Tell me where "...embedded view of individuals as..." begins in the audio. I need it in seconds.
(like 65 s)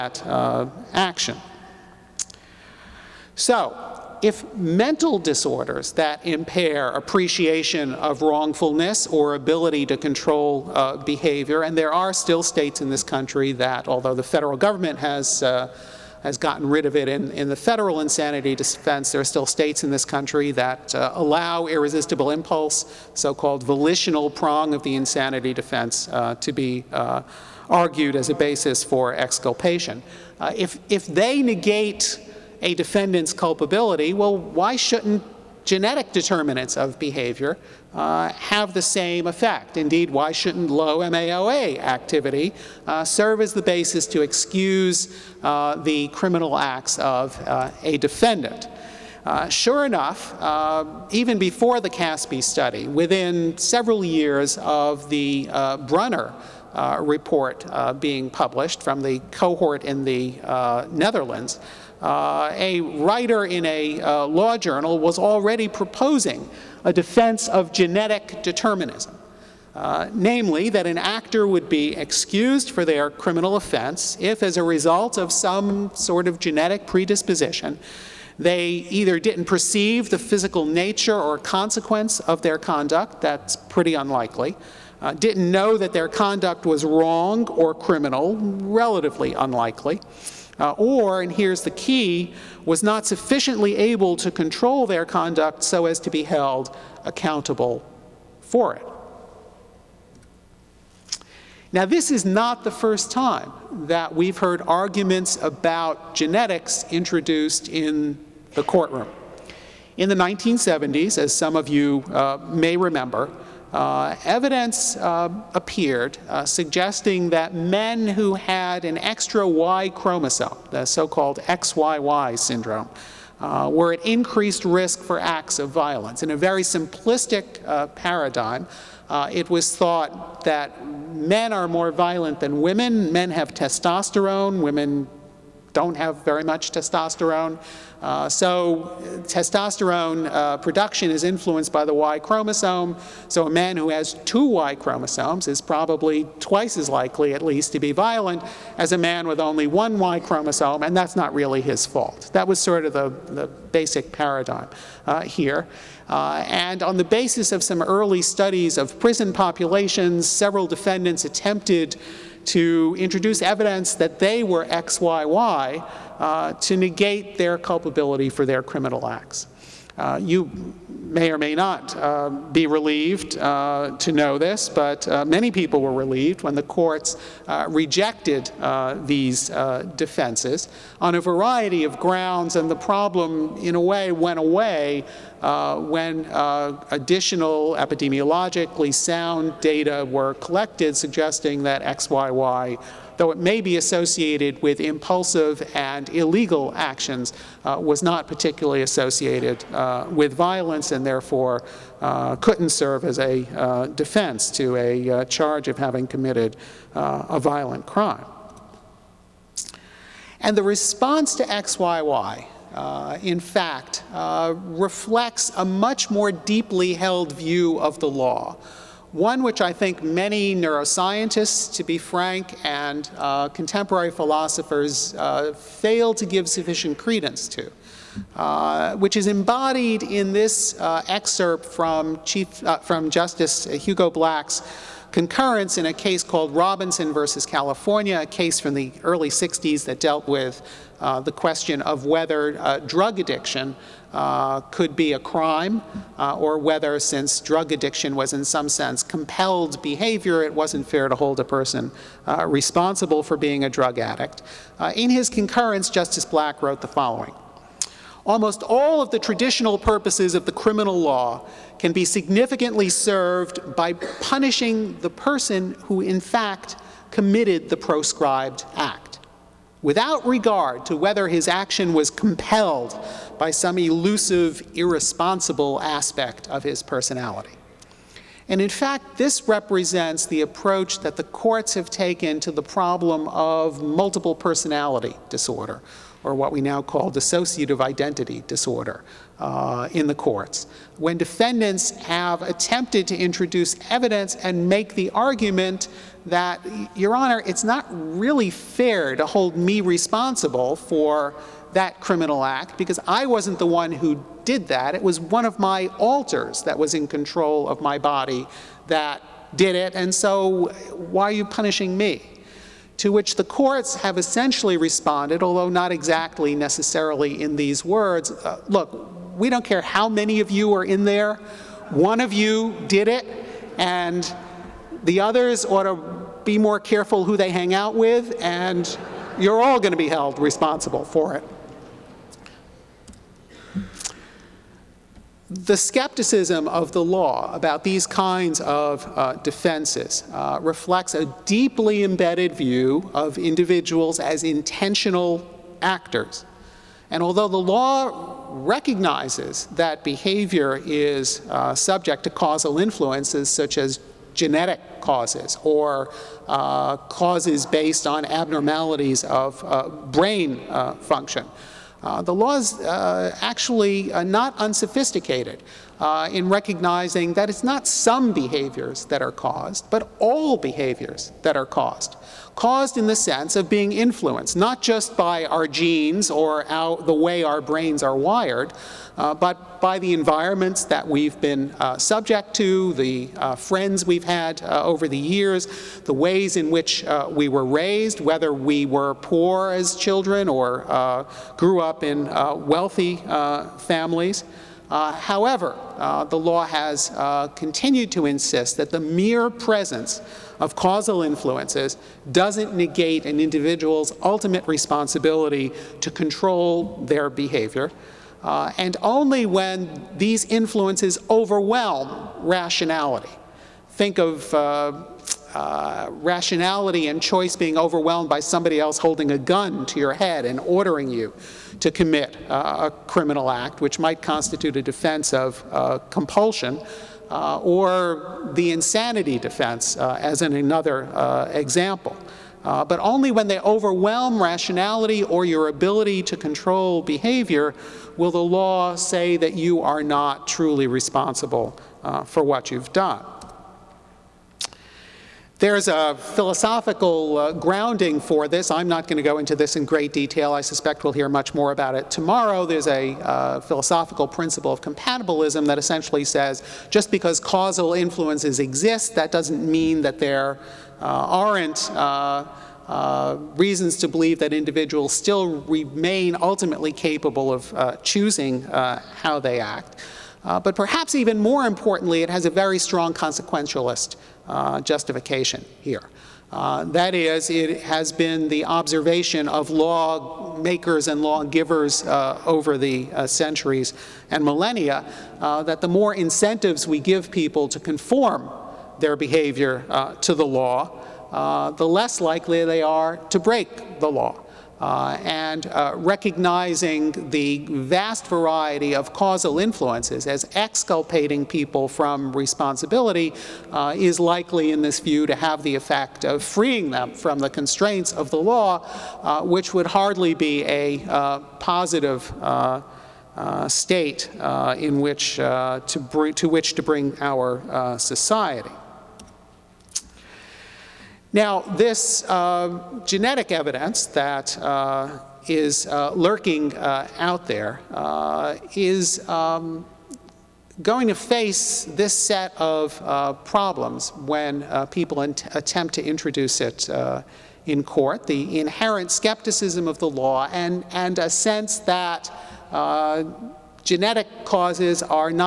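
342 s.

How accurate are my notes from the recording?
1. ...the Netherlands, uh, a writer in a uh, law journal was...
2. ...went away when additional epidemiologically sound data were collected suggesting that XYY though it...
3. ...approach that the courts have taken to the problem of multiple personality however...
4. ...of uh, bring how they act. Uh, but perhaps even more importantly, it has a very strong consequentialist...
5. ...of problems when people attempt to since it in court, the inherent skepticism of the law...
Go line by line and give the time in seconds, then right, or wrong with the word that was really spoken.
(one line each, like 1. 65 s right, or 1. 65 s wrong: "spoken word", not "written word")
1. 60 s right
2. 184 s right
3. 280 s wrong: "disorder", not "however"
4. 467 s wrong: "choosing", not "bring"
5. 532 s wrong: "introduce", not "since".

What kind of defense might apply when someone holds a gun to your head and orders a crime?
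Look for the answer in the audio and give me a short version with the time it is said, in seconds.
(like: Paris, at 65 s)
compulsion, at 426 s.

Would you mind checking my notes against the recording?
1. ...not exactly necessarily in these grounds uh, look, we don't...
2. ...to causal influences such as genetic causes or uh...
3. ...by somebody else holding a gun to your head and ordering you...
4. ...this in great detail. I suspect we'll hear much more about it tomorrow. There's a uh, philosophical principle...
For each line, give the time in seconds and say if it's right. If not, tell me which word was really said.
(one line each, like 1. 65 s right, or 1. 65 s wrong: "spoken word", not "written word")
1. 315 s wrong: "words", not "grounds"
2. 352 s right
3. 418 s right
4. 449 s right.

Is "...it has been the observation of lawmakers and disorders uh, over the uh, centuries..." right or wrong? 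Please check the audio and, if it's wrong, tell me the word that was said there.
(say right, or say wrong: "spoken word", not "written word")
wrong: "lawgivers", not "disorders".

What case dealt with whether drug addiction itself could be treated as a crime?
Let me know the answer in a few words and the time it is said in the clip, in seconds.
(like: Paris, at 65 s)
Robinson versus California, at 236 s.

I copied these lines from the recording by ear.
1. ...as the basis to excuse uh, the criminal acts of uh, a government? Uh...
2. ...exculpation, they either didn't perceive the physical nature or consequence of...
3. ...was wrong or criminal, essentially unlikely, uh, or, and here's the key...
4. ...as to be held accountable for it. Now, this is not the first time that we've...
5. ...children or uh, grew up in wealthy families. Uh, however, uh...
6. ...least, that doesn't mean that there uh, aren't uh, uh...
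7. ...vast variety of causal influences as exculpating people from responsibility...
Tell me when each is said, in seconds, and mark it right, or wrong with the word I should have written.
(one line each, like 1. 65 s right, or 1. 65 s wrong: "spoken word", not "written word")
1. 43 s wrong: "defendant", not "government"
2. 76 s wrong: "predisposition", not "exculpation"
3. 86 s wrong: "relatively", not "essentially"
4. 95 s right
5. 389 s right
6. 458 s wrong: "exist", not "least"
7. 497 s right.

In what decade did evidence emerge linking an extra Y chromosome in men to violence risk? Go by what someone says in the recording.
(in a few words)
1970s.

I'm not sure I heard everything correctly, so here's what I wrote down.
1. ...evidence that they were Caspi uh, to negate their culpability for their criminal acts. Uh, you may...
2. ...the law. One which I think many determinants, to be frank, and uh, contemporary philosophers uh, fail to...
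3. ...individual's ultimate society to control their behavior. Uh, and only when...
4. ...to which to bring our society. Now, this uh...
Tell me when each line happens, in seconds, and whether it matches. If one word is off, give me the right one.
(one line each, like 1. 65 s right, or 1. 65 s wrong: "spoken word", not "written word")
1. 163 s wrong: "XYY", not "Caspi"
2. 217 s wrong: "neuroscientists", not "determinants"
3. 403 s wrong: "responsibility", not "society"
4. 516 s right.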